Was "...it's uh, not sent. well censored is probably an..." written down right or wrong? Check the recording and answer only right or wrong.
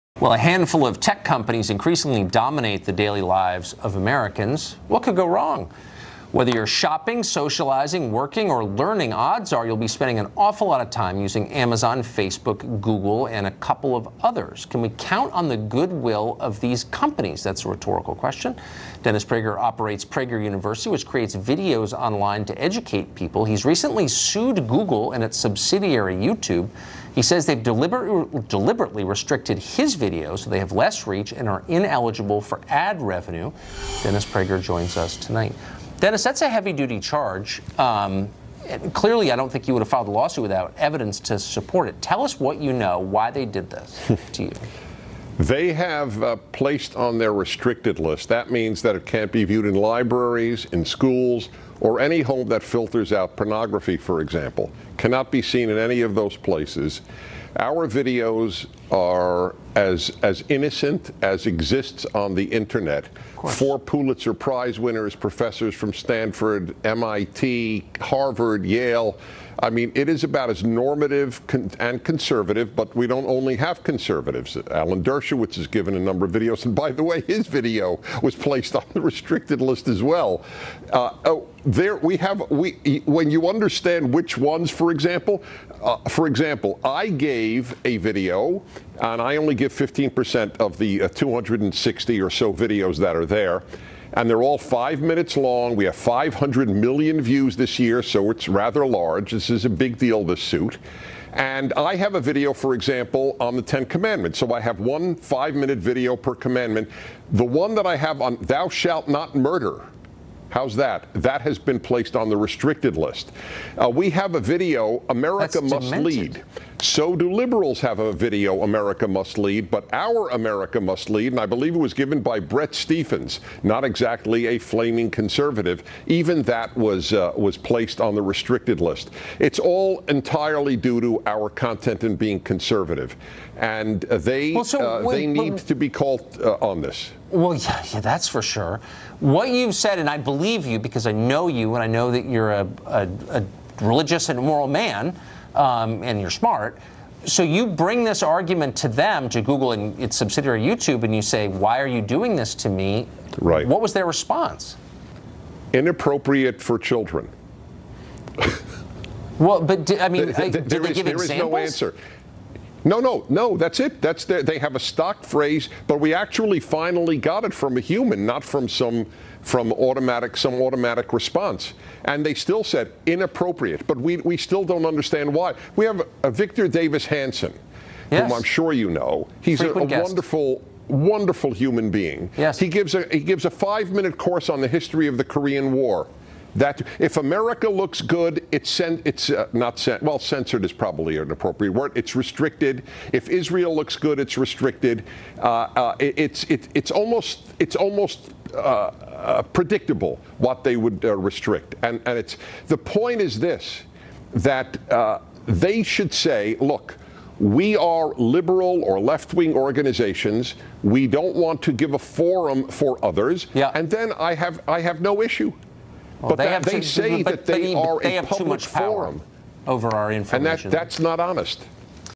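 right.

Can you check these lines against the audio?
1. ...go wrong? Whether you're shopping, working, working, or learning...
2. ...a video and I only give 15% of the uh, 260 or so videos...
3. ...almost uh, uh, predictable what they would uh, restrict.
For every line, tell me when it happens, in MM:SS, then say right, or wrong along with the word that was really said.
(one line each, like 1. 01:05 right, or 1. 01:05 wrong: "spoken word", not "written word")
1. 00:05 wrong: "socializing", not "working"
2. 01:27 right
3. 03:17 right.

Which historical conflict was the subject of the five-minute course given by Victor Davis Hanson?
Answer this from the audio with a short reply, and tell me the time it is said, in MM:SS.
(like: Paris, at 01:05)
Korean War, at 03:05.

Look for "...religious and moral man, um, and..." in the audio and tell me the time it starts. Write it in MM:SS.
02:23.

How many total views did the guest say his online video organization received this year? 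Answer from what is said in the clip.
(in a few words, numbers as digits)
500 million.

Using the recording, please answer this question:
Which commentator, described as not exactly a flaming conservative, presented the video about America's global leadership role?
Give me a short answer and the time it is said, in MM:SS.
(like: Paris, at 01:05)
Bret Stephens, at 02:02.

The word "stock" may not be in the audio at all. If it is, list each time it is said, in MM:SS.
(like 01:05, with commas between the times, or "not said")
02:44.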